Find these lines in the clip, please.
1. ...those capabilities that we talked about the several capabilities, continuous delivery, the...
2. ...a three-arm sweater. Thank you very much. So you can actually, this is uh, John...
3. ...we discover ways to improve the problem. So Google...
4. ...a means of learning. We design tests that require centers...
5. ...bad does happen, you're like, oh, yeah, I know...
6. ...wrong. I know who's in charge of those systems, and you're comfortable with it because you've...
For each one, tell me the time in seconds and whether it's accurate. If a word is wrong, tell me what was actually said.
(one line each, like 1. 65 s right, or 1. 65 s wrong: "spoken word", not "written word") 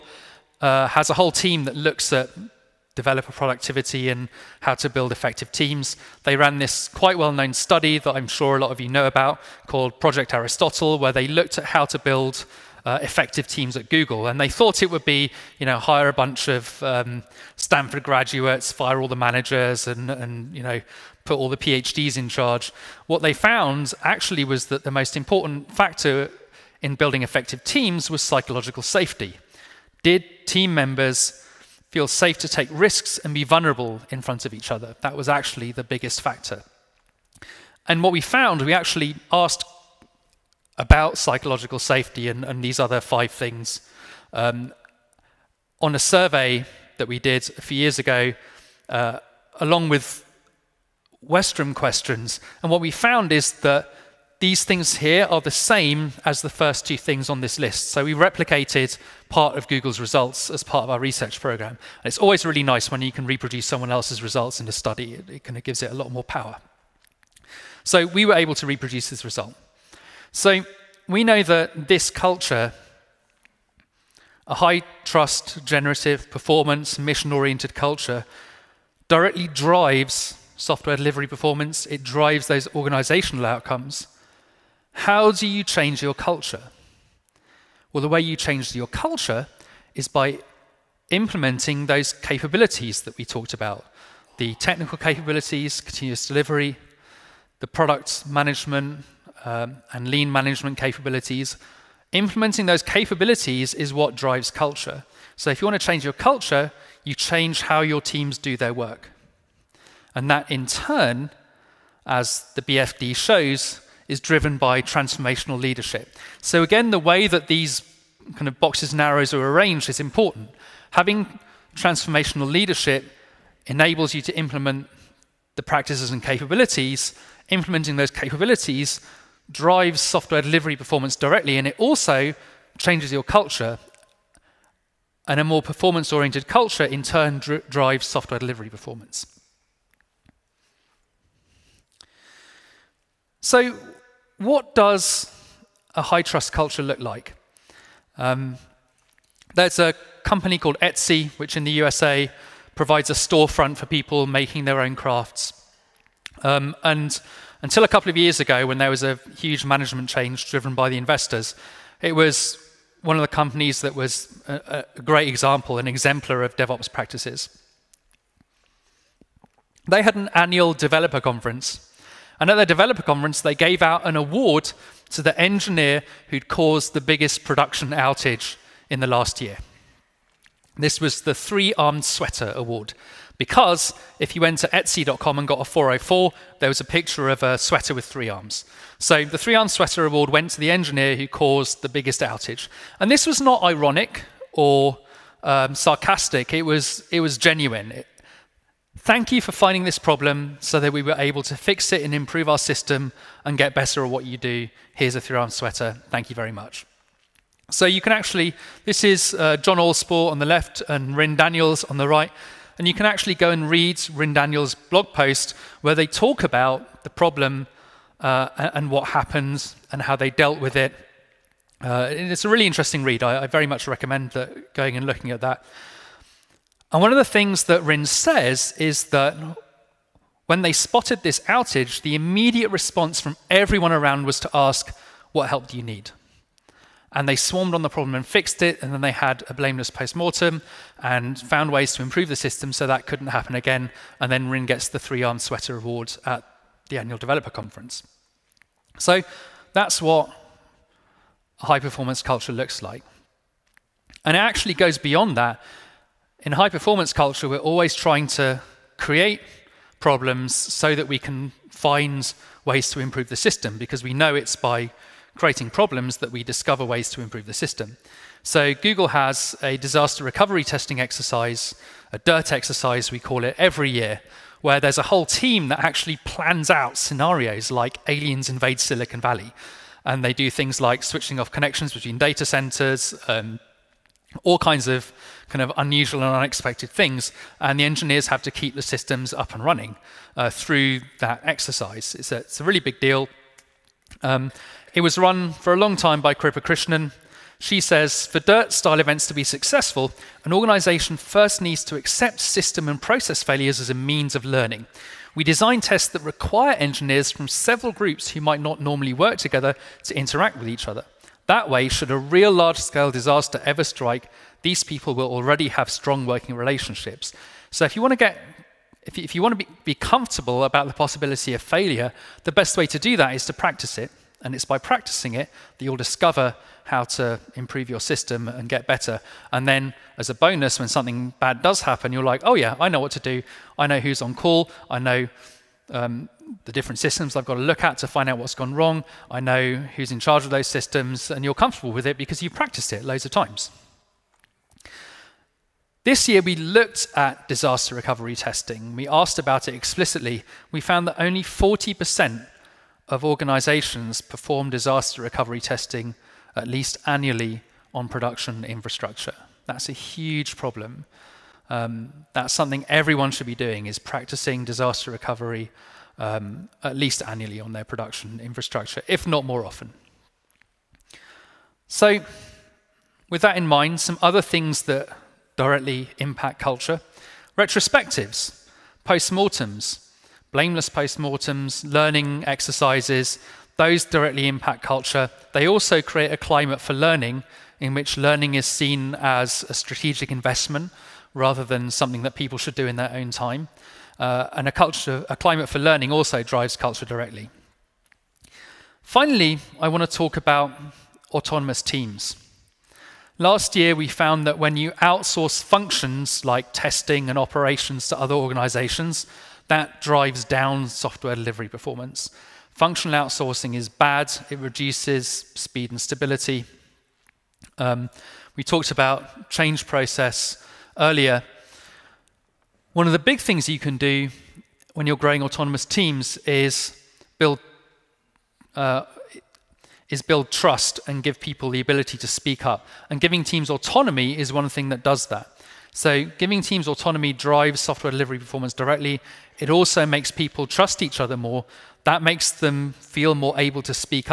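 1. 91 s wrong: "technical", not "several"
2. 205 s right
3. 266 s wrong: "system", not "problem"
4. 303 s wrong: "engineers", not "centers"
5. 331 s right
6. 338 s right.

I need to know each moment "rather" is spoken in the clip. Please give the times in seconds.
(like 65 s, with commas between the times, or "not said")
391 s.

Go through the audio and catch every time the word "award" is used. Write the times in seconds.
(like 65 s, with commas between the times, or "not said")
174 s, 182 s, 190 s, 245 s.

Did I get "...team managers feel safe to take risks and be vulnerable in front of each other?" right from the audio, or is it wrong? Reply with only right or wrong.
wrong.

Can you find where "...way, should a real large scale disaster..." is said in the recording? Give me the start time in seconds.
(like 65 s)
311 s.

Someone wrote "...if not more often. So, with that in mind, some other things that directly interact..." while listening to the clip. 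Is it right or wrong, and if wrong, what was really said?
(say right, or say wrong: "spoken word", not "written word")
wrong: "impact", not "interact".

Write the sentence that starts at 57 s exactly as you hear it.
So we replicated part of Google's results as part of our research program.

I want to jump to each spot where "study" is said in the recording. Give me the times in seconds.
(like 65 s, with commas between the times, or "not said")
7 s, 64 s.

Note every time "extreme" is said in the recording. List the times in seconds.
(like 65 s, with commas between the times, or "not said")
not said.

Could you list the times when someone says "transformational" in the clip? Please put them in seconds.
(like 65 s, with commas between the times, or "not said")
114 s, 121 s.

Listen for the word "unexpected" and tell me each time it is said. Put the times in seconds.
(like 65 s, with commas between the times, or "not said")
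286 s.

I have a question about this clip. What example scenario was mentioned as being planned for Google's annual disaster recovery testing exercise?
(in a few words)
aliens invade Silicon Valley.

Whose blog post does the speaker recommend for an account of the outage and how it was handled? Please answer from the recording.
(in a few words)
Ryn Daniels.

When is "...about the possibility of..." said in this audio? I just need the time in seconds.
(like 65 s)
320 s.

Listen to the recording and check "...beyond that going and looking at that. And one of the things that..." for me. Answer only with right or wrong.
wrong.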